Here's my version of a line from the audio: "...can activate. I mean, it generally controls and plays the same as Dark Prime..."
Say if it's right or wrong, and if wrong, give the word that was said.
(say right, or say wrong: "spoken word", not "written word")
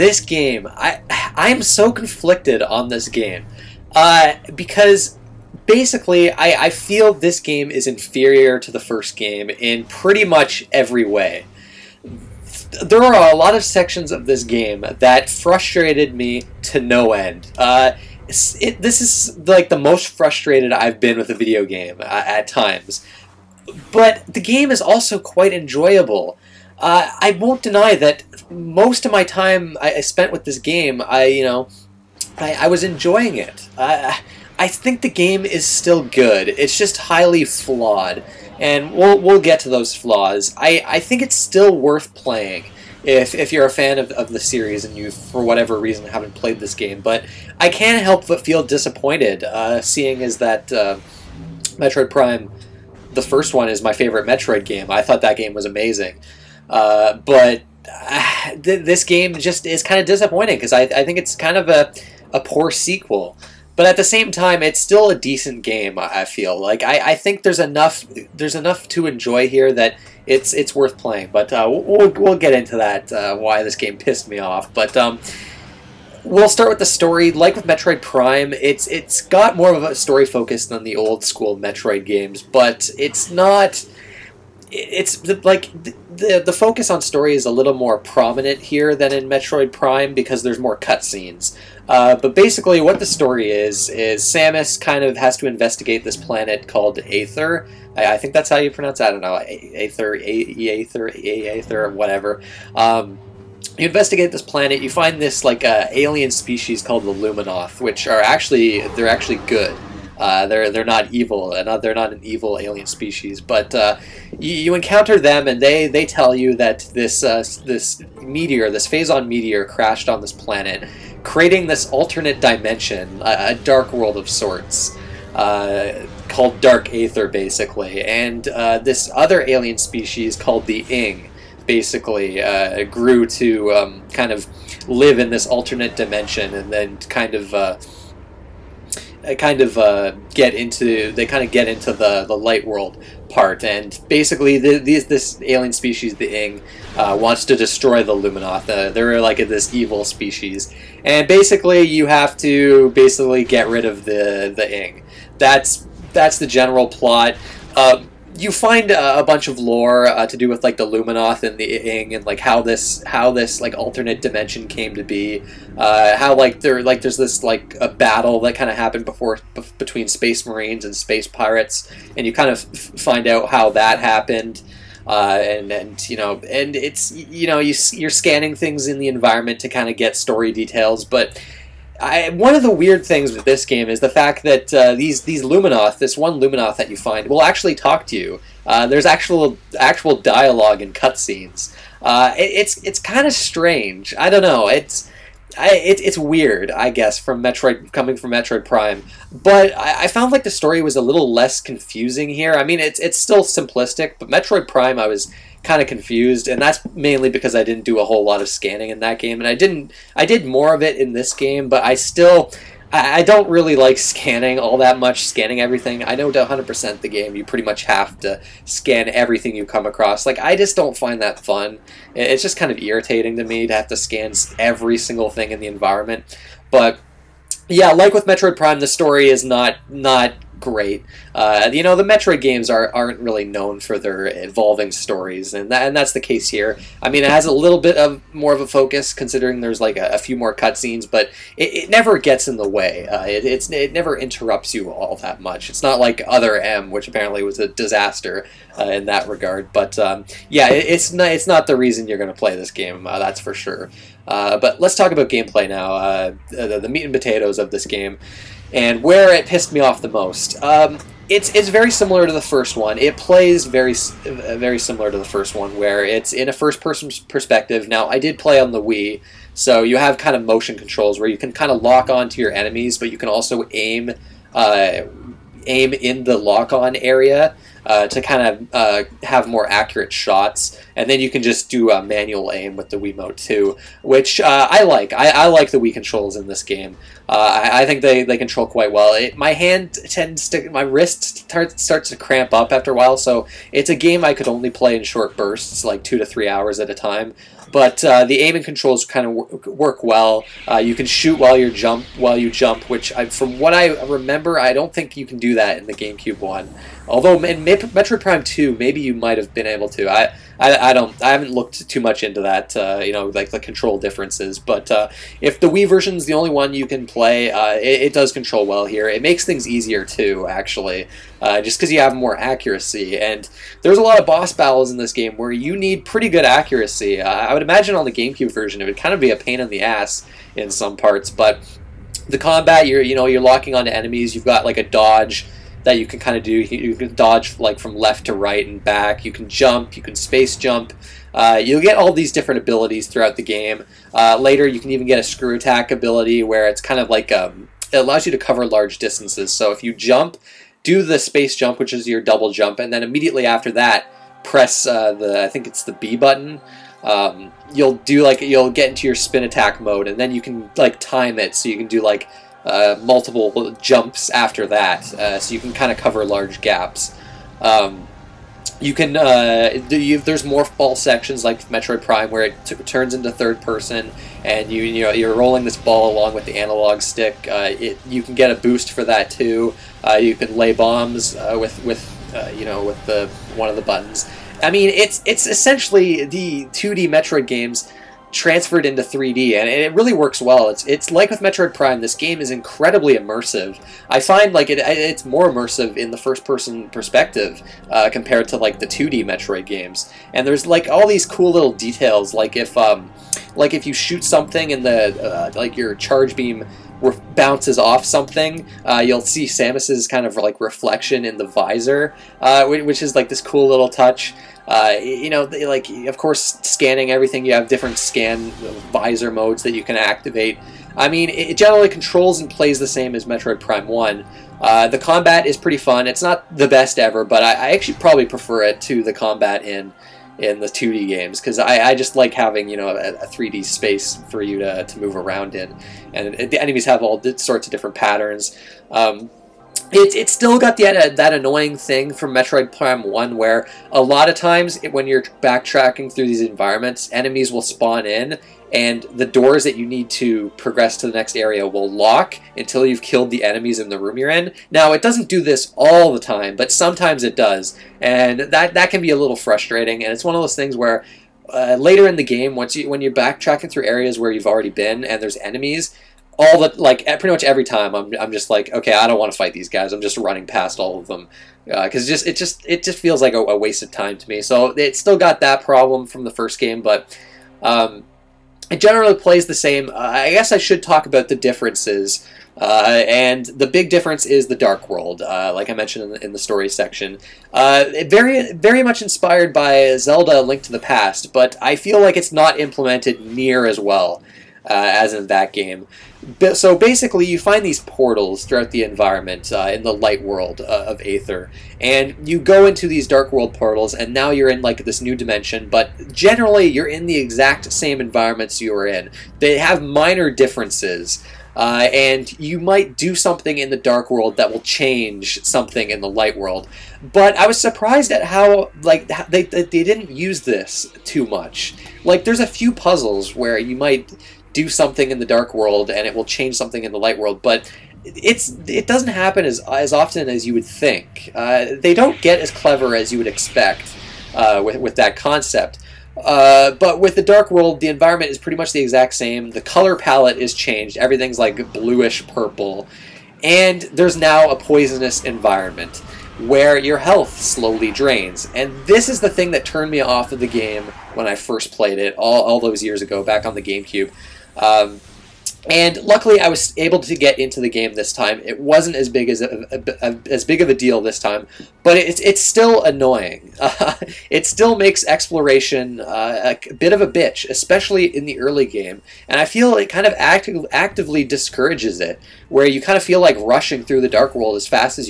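wrong: "Metroid", not "Dark".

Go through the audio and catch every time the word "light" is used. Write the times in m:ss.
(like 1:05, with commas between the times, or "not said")
2:22, 8:19, 8:36, 8:46.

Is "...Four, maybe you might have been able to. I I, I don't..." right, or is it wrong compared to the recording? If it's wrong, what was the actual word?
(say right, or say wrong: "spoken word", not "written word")
wrong: "Two", not "Four".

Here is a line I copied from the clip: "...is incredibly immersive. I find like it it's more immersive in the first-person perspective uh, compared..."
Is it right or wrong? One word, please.
right.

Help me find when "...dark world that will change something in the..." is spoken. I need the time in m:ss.
8:33.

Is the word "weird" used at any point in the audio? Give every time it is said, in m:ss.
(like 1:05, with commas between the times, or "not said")
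3:02, 3:16.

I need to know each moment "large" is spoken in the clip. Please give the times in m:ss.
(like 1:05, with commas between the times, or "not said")
5:48, 6:06.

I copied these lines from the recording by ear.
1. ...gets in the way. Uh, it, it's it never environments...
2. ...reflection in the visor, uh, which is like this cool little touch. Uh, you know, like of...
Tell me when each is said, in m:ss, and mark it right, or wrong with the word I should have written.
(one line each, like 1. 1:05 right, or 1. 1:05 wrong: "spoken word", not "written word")
1. 4:02 wrong: "interrupts", not "environments"
2. 6:50 right.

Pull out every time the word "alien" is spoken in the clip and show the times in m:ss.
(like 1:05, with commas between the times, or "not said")
1:45, 1:52, 2:09, 2:25.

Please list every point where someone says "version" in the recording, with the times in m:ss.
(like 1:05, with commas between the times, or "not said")
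5:15, 5:28.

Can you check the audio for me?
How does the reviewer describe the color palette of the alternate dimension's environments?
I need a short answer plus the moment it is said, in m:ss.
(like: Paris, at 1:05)
bluish purple, at 9:01.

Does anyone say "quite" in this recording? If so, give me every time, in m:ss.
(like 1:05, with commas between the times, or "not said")
0:25, 4:48.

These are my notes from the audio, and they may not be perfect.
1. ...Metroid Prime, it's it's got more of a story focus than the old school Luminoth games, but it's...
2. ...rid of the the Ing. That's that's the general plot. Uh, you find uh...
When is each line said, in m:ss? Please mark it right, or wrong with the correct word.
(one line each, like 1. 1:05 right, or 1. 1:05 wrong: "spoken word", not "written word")
1. 1:17 wrong: "Metroid", not "Luminoth"
2. 2:33 right.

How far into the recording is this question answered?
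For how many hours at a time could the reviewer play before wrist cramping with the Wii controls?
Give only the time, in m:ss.
4:56.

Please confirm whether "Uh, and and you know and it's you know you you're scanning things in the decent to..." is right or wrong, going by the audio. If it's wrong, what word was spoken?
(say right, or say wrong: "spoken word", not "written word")
wrong: "environment", not "decent".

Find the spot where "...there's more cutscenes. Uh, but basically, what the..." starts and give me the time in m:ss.
1:30.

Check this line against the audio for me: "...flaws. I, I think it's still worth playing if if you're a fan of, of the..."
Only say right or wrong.
right.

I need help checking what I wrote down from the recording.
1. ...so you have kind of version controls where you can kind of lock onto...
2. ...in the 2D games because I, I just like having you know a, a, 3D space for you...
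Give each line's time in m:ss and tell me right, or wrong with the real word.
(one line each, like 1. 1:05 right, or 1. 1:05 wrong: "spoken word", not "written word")
1. 4:29 wrong: "motion", not "version"
2. 7:10 right.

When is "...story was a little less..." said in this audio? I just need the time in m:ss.
3:20.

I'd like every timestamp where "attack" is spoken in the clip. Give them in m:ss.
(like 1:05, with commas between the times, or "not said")
5:45, 5:59.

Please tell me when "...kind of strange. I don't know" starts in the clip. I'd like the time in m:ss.
3:12.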